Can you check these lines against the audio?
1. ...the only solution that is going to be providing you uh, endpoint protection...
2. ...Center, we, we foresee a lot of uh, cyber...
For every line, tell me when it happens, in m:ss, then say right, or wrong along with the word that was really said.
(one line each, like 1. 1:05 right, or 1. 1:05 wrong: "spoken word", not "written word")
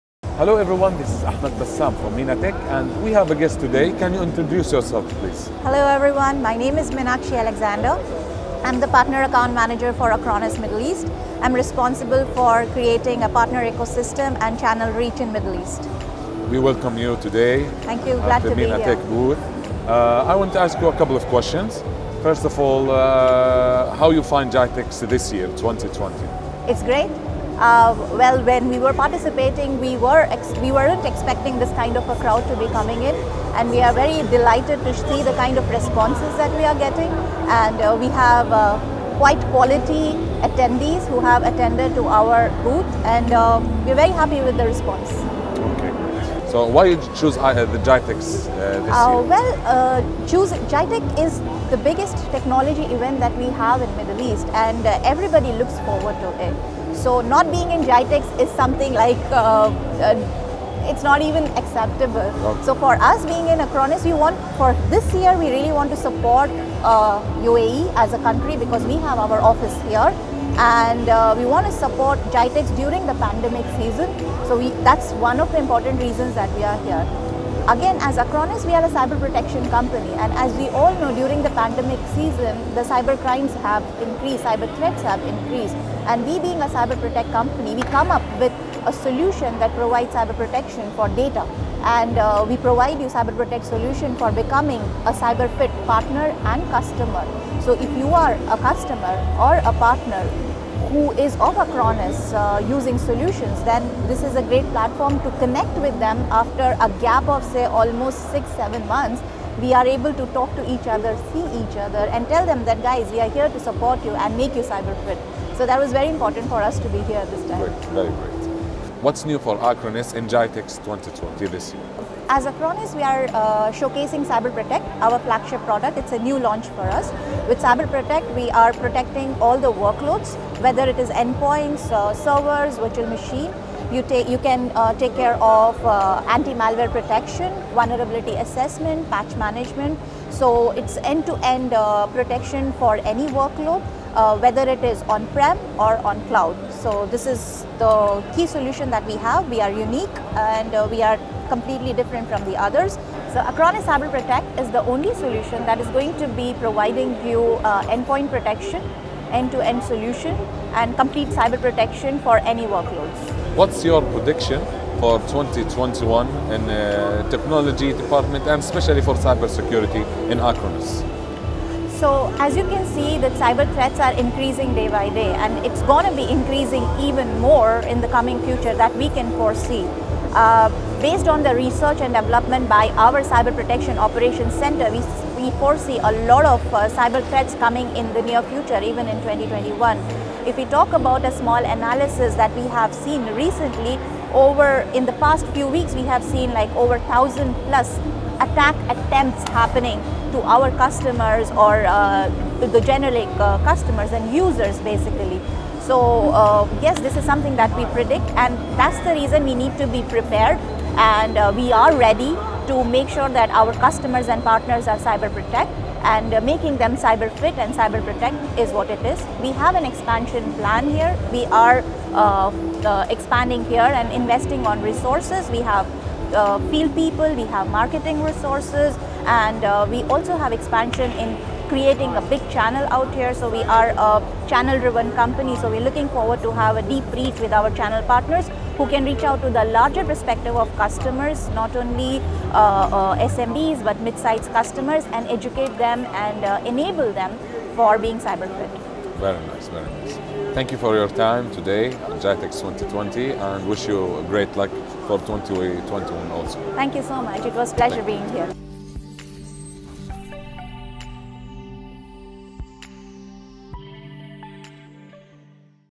1. 2:34 right
2. 3:04 right.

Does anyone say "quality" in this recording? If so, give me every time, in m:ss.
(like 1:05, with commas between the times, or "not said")
0:39.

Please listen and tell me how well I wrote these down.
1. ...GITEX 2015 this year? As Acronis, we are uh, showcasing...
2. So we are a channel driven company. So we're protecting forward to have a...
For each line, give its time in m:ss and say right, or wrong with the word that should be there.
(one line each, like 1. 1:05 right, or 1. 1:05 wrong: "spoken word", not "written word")
1. 2:00 wrong: "2020", not "2015"
2. 3:53 wrong: "looking", not "protecting".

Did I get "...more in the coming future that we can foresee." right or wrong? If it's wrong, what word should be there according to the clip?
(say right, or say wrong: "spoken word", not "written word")
right.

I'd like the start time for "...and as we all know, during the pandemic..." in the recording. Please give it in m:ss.
1:20.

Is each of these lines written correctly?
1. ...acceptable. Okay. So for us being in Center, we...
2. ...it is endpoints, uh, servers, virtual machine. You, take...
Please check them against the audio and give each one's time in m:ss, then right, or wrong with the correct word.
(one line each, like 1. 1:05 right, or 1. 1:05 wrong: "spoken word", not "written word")
1. 1:01 wrong: "Acronis", not "Center"
2. 2:10 right.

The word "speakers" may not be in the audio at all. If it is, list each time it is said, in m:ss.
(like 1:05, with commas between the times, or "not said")
not said.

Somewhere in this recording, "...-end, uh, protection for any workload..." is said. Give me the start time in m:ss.
2:21.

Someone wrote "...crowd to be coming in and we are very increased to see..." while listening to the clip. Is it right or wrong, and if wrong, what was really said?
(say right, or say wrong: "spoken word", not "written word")
wrong: "delighted", not "increased".